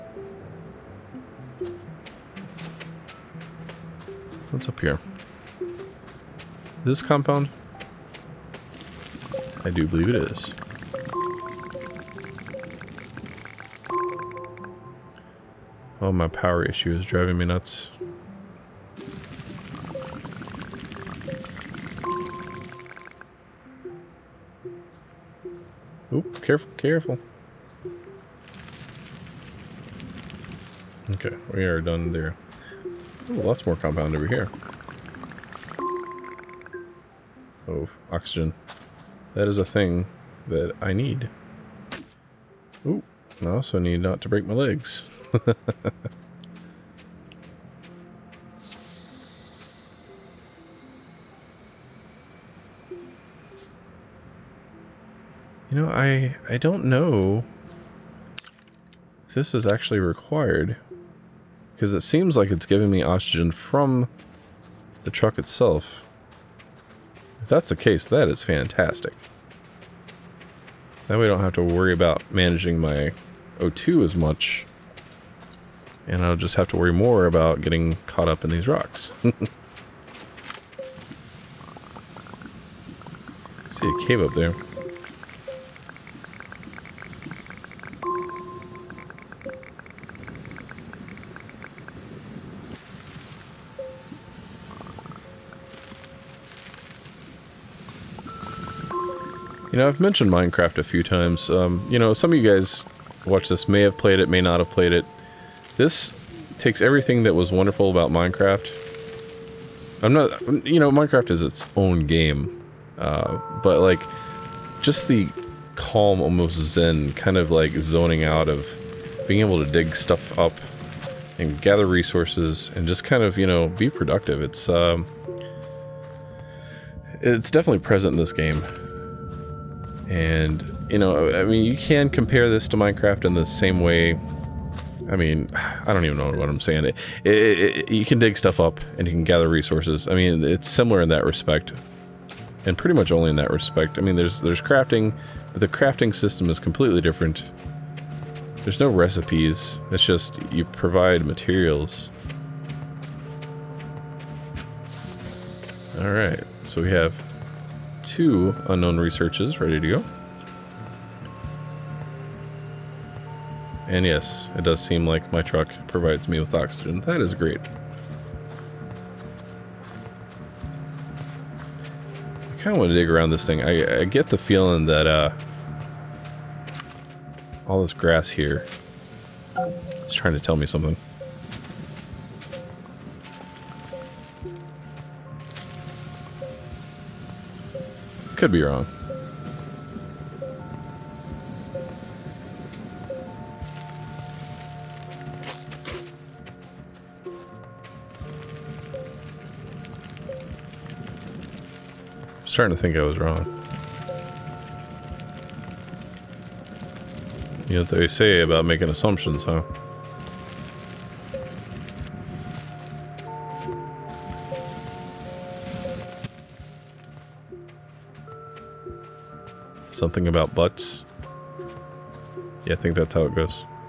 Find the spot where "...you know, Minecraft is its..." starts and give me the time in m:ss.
1:50.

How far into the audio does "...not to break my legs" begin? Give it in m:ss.
0:43.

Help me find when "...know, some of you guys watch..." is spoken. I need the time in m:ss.
1:41.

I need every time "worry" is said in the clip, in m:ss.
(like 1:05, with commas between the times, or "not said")
1:11, 1:16.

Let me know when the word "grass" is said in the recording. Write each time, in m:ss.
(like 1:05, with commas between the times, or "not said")
2:57.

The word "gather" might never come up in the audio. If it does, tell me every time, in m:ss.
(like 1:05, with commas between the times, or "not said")
2:01, 2:19.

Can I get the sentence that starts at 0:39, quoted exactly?
That is a thing that I need.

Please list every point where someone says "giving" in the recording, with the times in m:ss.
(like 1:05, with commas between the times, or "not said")
1:02.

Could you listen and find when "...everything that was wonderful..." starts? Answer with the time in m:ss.
1:46.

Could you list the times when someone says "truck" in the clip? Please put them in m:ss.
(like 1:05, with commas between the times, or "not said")
1:05, 2:45.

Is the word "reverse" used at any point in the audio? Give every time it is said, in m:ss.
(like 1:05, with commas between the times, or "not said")
not said.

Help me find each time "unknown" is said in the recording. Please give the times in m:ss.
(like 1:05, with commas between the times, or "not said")
2:38.